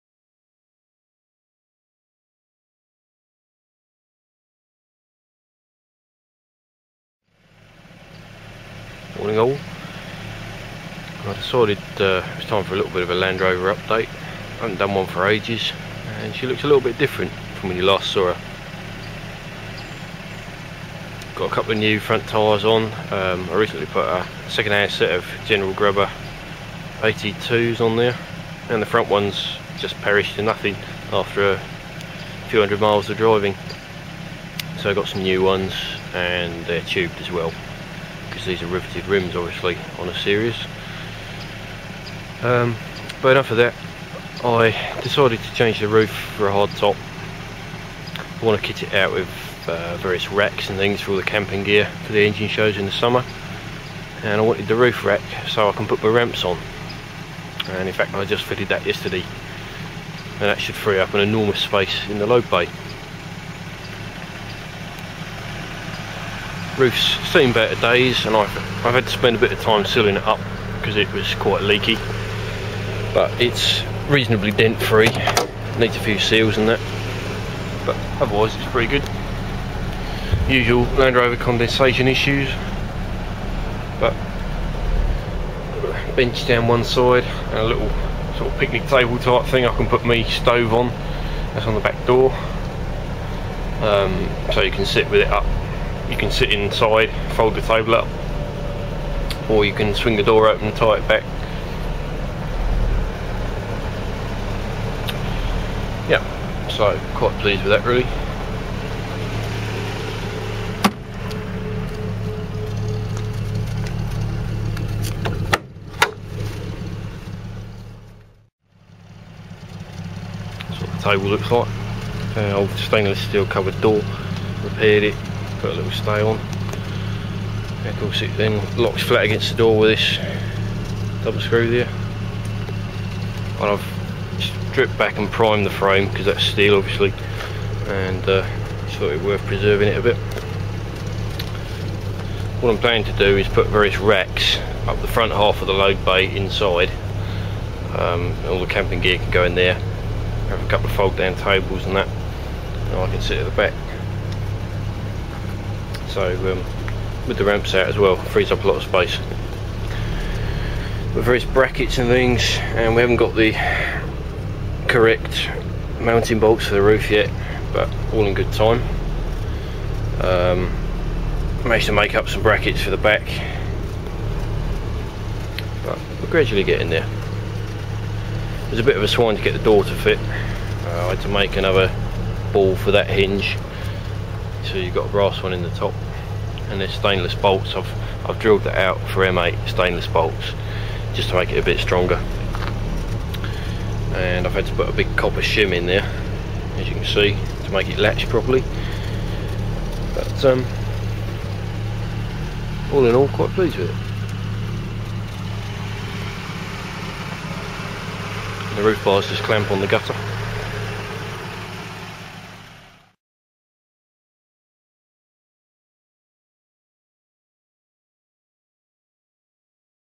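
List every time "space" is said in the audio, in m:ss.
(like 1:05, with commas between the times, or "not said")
1:01, 2:38.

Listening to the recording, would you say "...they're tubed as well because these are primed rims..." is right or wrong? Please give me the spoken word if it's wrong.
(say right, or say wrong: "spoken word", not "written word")
wrong: "riveted", not "primed".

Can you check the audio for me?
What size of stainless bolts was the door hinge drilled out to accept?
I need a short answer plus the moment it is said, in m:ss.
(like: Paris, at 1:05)
M8, at 3:09.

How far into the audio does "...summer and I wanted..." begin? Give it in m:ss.
0:52.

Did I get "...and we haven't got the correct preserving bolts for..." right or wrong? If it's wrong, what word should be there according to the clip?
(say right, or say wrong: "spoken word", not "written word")
wrong: "mounting", not "preserving".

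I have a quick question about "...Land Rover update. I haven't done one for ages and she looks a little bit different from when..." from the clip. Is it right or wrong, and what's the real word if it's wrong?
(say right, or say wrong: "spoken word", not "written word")
right.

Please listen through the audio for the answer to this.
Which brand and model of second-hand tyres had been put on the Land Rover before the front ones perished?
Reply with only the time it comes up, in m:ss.
0:25.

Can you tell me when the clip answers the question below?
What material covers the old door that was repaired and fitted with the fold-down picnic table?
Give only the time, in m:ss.
2:02.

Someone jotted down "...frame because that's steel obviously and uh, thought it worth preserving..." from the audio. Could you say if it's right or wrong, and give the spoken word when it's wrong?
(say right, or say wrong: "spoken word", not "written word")
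right.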